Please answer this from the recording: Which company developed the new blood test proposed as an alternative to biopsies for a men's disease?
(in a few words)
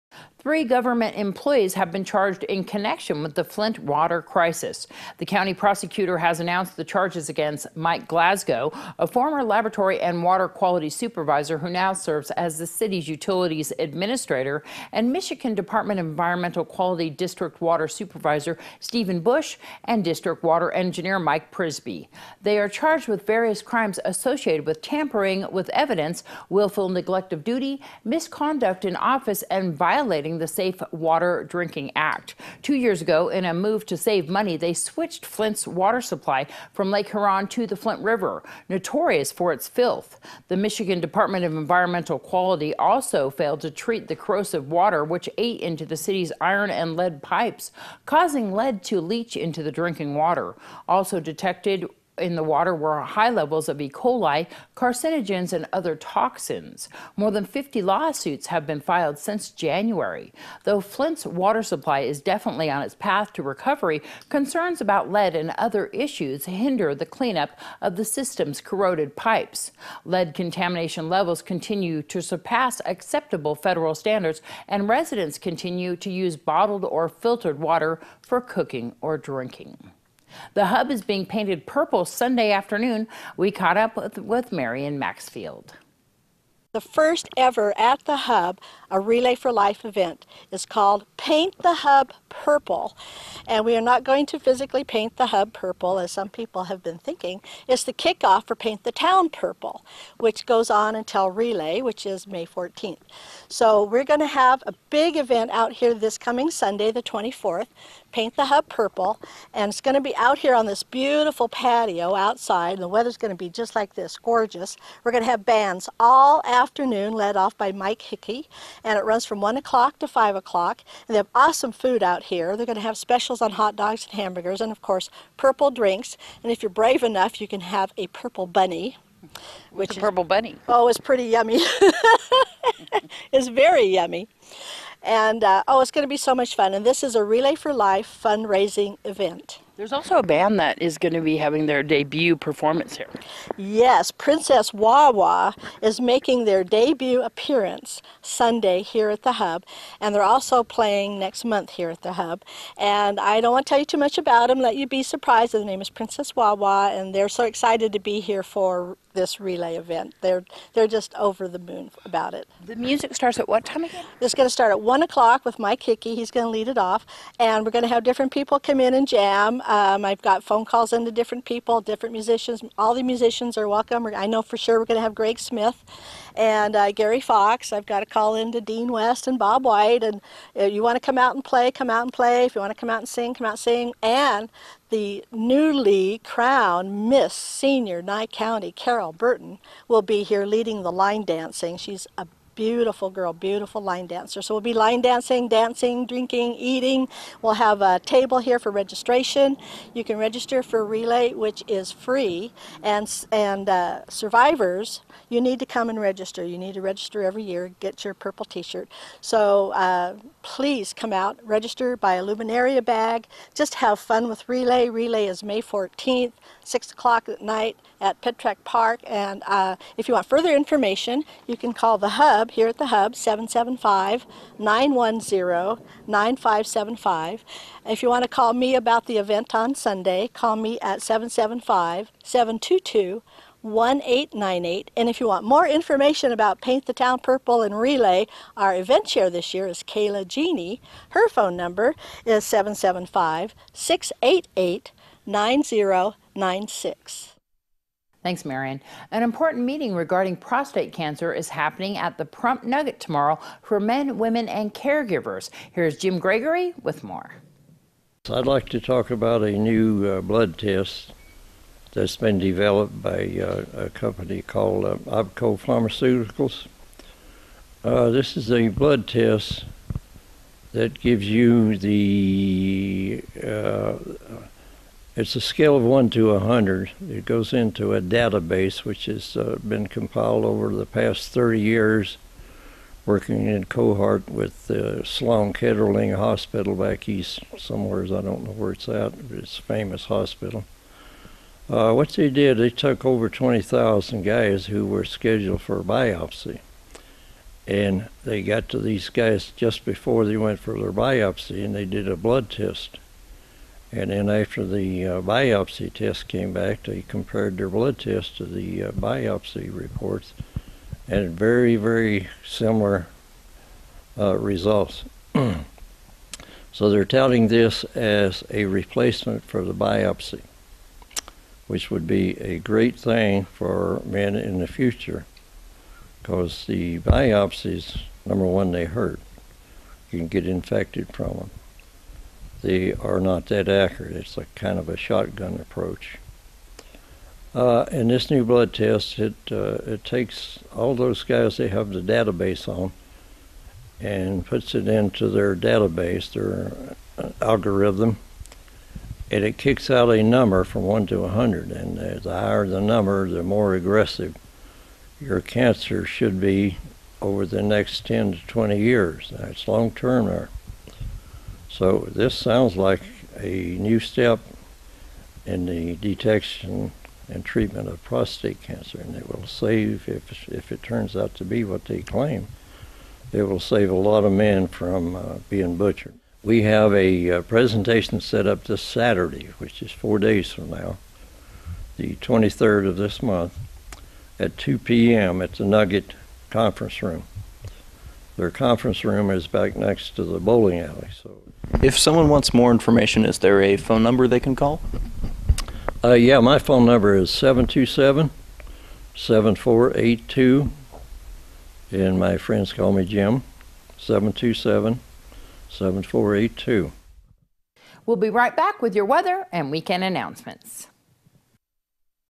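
OPKO Pharmaceuticals.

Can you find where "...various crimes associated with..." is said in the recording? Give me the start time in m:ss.
0:23.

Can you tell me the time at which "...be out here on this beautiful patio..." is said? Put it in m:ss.
1:50.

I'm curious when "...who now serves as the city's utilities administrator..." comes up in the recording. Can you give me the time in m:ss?
0:11.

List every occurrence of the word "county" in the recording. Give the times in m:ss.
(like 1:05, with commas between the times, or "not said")
0:05, 3:08.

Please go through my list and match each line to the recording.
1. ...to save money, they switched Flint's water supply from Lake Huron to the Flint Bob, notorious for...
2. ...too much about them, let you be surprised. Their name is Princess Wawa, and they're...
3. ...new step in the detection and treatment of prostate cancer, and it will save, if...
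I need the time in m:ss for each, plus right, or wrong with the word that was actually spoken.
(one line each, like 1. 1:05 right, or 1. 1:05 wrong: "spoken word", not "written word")
1. 0:33 wrong: "River", not "Bob"
2. 2:33 right
3. 6:03 right.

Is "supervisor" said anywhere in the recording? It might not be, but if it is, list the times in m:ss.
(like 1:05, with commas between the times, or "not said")
0:10, 0:17.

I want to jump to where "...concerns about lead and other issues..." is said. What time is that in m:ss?
1:04.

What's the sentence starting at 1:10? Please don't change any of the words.
Lead contamination levels continue to surpass acceptable federal standards, and residents continue to use bottled or filtered water for cooking or drinking.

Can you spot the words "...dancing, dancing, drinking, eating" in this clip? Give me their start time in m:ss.
3:15.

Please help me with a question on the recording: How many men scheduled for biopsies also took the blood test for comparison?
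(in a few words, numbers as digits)
Over 20,000.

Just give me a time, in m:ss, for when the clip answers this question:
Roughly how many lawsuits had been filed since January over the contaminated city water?
0:57.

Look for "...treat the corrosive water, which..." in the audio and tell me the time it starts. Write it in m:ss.
0:43.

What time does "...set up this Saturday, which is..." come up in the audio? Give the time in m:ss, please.
6:18.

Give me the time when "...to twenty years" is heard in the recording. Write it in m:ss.
5:58.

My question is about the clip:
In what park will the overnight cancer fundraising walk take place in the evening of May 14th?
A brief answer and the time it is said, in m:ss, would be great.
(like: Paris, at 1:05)
Petrack Park, at 3:38.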